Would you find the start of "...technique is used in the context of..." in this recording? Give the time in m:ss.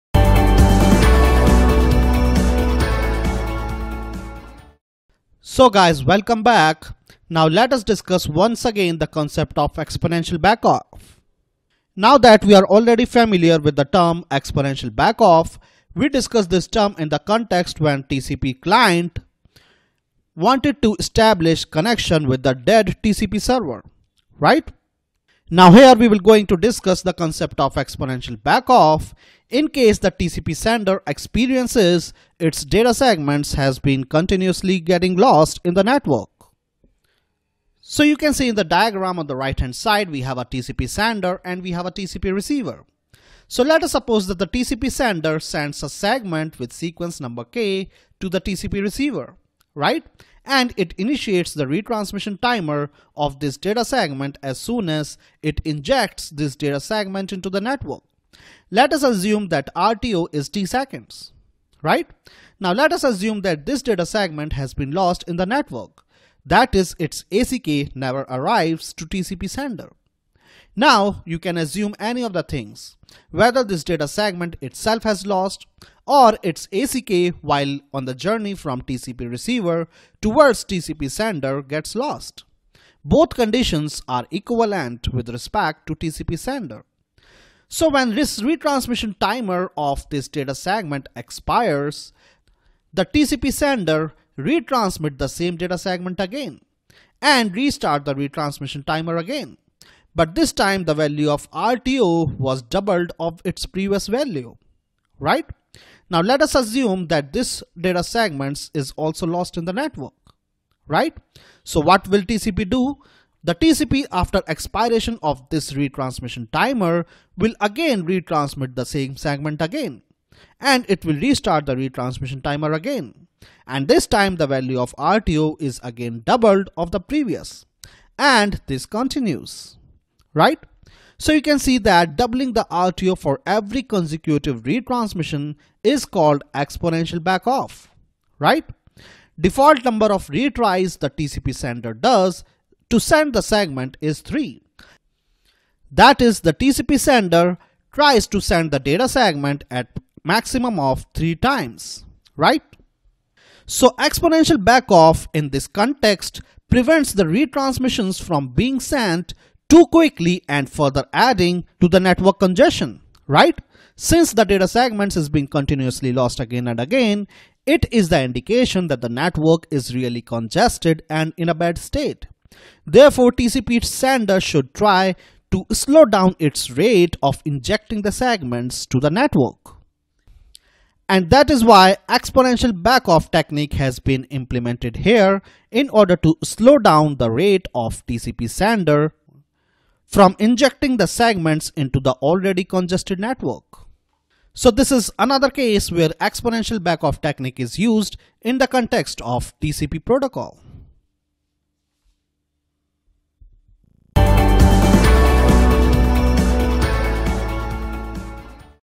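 3:17.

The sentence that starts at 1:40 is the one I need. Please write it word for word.
But this time the value of RTO was doubled of its previous value, right?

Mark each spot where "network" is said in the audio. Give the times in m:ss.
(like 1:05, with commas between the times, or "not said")
0:35, 0:57, 1:05, 1:49, 2:42, 2:49, 2:59, 3:13.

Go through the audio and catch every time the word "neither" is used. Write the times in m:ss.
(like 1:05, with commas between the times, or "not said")
not said.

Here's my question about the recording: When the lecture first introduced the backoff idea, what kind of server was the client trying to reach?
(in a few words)
dead TCP server.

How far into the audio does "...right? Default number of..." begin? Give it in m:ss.
2:18.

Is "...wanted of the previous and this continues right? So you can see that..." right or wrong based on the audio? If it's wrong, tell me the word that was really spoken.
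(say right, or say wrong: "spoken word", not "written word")
wrong: "doubled", not "wanted".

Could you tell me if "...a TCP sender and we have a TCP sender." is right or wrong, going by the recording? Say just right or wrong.
wrong.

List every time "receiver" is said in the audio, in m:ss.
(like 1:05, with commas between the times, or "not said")
0:42, 0:48, 1:19.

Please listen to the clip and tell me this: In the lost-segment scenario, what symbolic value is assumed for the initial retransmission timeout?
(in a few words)
t seconds.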